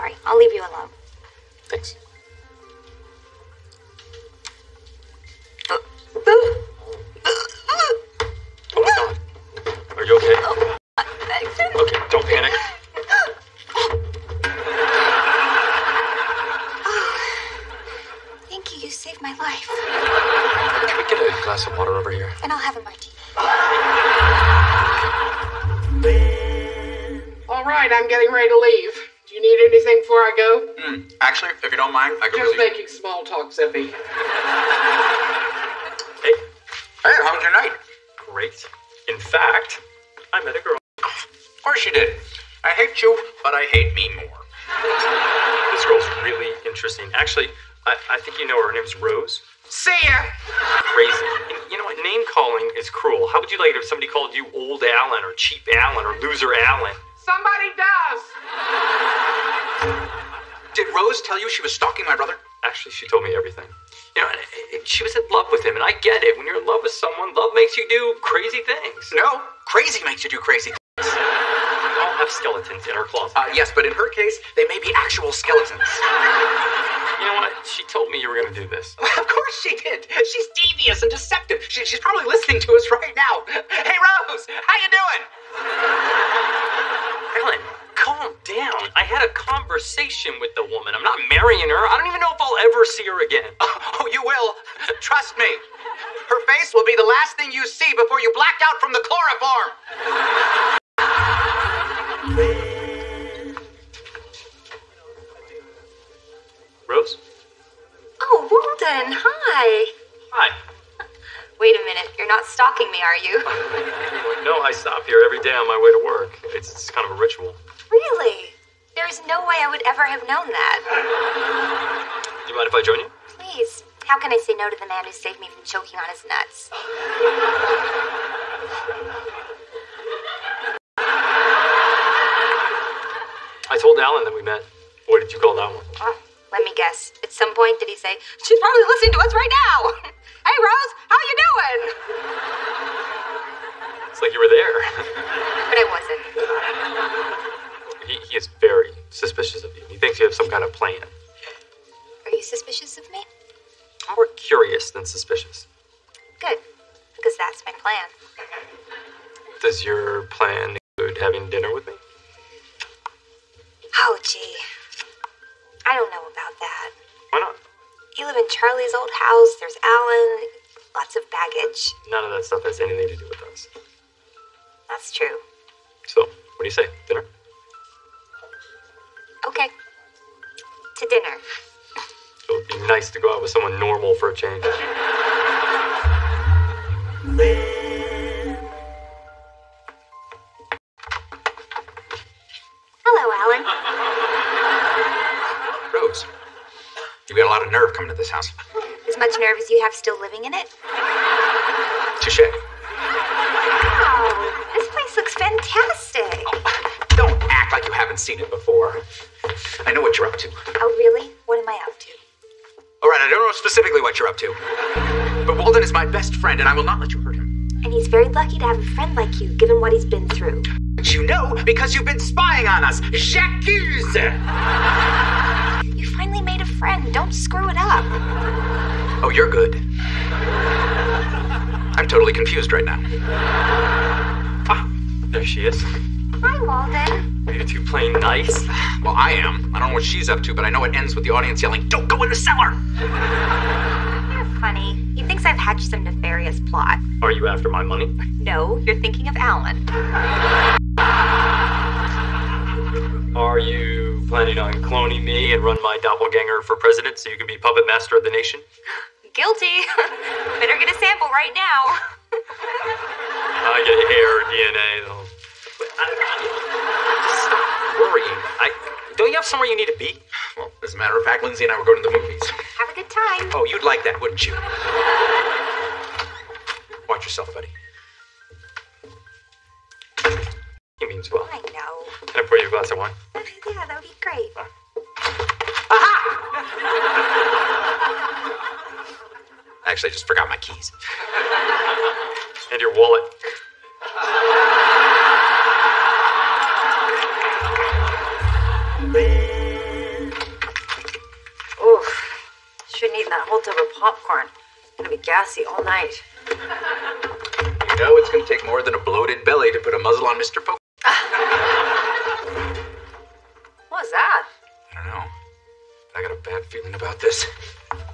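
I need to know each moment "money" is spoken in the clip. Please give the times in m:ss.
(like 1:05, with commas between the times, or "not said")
4:07.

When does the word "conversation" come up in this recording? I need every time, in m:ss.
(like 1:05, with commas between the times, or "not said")
1:29.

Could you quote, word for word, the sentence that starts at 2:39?
Does your plan include having dinner with me?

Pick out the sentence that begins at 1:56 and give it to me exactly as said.
It's, it's kind of a ritual.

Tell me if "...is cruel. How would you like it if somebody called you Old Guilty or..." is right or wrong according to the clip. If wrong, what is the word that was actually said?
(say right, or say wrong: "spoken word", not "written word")
wrong: "Alan", not "Guilty".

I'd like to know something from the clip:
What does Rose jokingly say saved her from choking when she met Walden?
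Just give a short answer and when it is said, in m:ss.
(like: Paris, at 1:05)
his nuts, at 2:05.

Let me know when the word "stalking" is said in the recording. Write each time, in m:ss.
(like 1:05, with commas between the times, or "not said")
1:01, 1:52.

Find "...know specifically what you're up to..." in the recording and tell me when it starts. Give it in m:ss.
3:33.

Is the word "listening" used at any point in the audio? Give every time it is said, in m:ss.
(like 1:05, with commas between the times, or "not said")
1:22, 2:18.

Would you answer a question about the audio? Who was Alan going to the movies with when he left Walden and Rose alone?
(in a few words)
Lindsay.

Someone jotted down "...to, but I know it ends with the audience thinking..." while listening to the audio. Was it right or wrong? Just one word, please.
wrong.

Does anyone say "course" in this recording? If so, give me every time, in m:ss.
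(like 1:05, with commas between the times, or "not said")
0:41, 1:19.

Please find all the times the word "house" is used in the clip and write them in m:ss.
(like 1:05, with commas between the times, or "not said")
2:49, 3:18.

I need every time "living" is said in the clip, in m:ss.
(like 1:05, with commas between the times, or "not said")
3:20.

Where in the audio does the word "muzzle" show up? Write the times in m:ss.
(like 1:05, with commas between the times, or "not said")
5:09.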